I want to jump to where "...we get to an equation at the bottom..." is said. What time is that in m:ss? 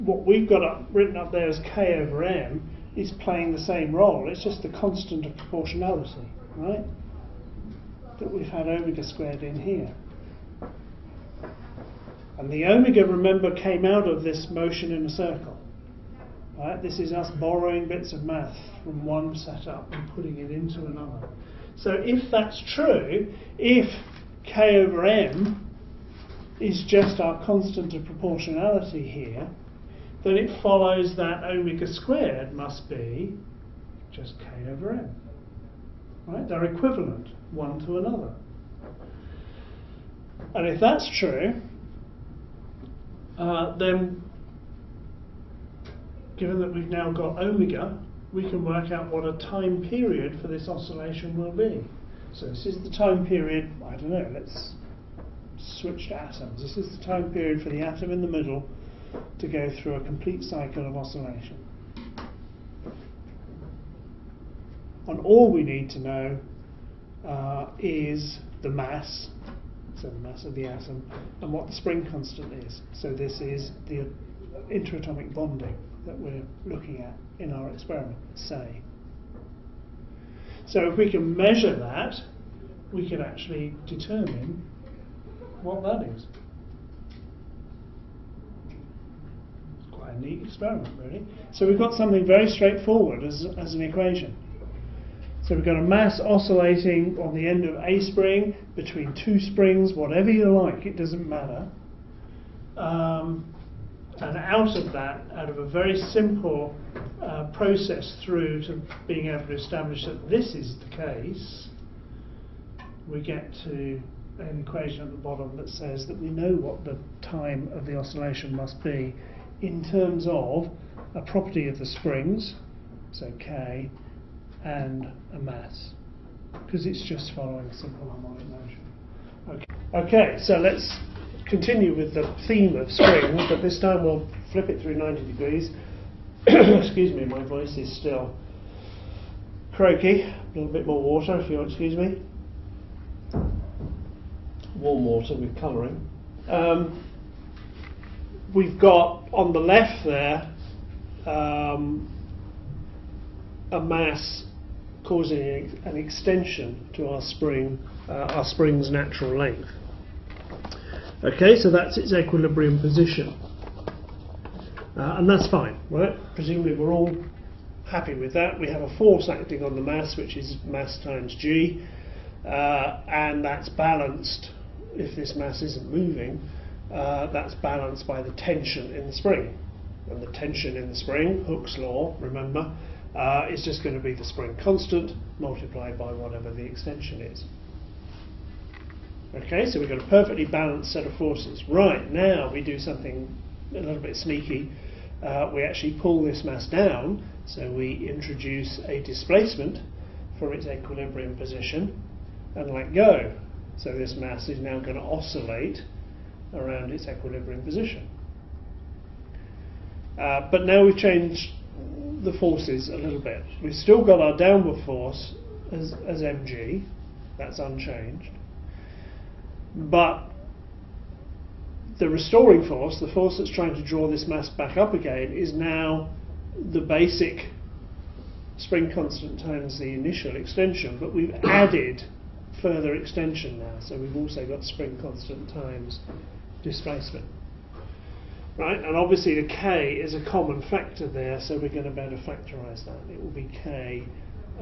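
1:53.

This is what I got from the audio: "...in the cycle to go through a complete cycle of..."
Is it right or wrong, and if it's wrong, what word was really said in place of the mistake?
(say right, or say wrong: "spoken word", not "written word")
wrong: "middle", not "cycle".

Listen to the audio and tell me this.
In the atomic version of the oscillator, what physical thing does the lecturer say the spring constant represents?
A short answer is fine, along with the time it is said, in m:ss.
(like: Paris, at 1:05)
interatomic bonding, at 1:14.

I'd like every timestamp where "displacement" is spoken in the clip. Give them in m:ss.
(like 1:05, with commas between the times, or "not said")
3:19, 3:56.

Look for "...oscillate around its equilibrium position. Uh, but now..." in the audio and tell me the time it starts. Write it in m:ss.
3:25.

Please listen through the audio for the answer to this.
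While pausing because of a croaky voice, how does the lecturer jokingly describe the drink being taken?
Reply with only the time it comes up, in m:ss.
2:24.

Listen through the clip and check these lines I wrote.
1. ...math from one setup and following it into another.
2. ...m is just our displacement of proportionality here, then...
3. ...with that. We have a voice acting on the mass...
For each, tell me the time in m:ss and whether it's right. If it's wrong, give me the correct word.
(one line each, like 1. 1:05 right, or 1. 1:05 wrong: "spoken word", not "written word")
1. 0:18 wrong: "putting", not "following"
2. 0:25 wrong: "constant", not "displacement"
3. 2:48 wrong: "force", not "voice".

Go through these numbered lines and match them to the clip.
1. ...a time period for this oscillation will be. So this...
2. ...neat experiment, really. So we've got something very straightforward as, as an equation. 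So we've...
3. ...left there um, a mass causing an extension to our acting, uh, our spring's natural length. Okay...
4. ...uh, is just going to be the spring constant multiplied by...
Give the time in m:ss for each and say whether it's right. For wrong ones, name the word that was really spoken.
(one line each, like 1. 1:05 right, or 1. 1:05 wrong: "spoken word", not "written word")
1. 0:49 right
2. 1:30 right
3. 2:29 wrong: "spring", not "acting"
4. 3:03 right.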